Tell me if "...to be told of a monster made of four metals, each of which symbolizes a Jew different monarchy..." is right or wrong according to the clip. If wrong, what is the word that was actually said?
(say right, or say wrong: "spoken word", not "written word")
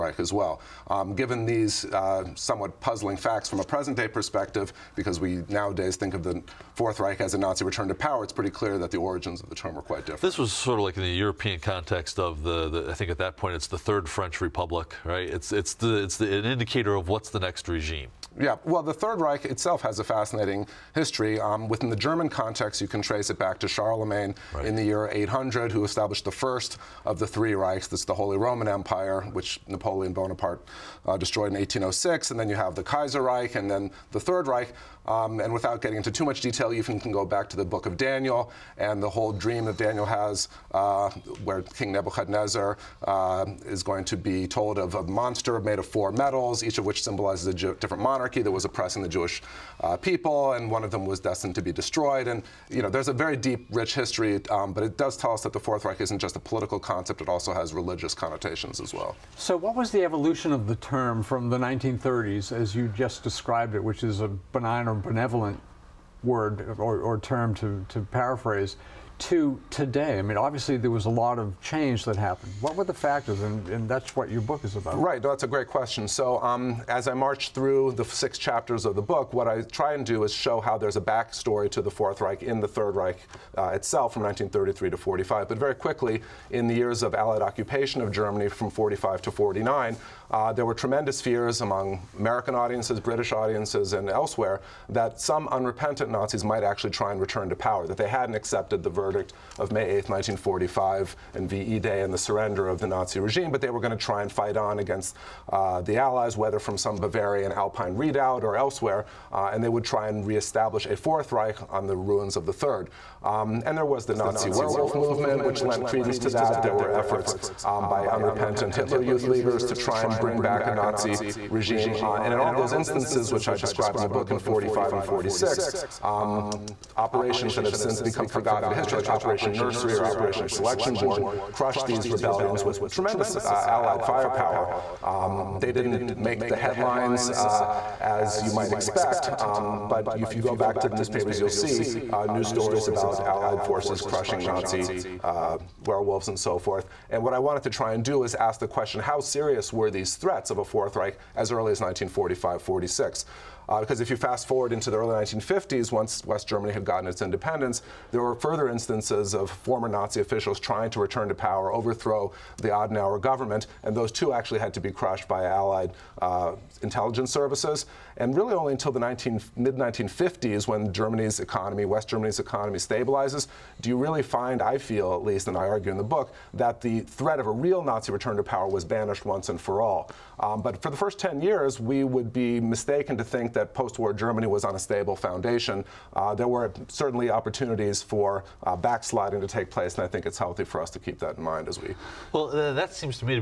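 right.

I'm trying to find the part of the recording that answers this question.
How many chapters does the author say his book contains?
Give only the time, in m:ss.
1:18.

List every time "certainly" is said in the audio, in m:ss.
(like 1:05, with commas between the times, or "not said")
3:06.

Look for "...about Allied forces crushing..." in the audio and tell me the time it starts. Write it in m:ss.
2:22.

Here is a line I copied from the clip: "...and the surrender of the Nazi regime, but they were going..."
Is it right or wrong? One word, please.
right.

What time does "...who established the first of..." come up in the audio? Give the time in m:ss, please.
0:25.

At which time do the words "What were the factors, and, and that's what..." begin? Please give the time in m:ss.
1:12.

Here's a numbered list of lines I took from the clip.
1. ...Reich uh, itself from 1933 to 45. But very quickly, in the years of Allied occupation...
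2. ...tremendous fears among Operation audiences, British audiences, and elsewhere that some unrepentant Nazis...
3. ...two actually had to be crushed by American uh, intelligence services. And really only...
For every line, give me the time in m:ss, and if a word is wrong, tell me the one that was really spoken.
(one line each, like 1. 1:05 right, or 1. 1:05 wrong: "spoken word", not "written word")
1. 1:22 right
2. 1:30 wrong: "American", not "Operation"
3. 2:44 wrong: "Allied", not "American".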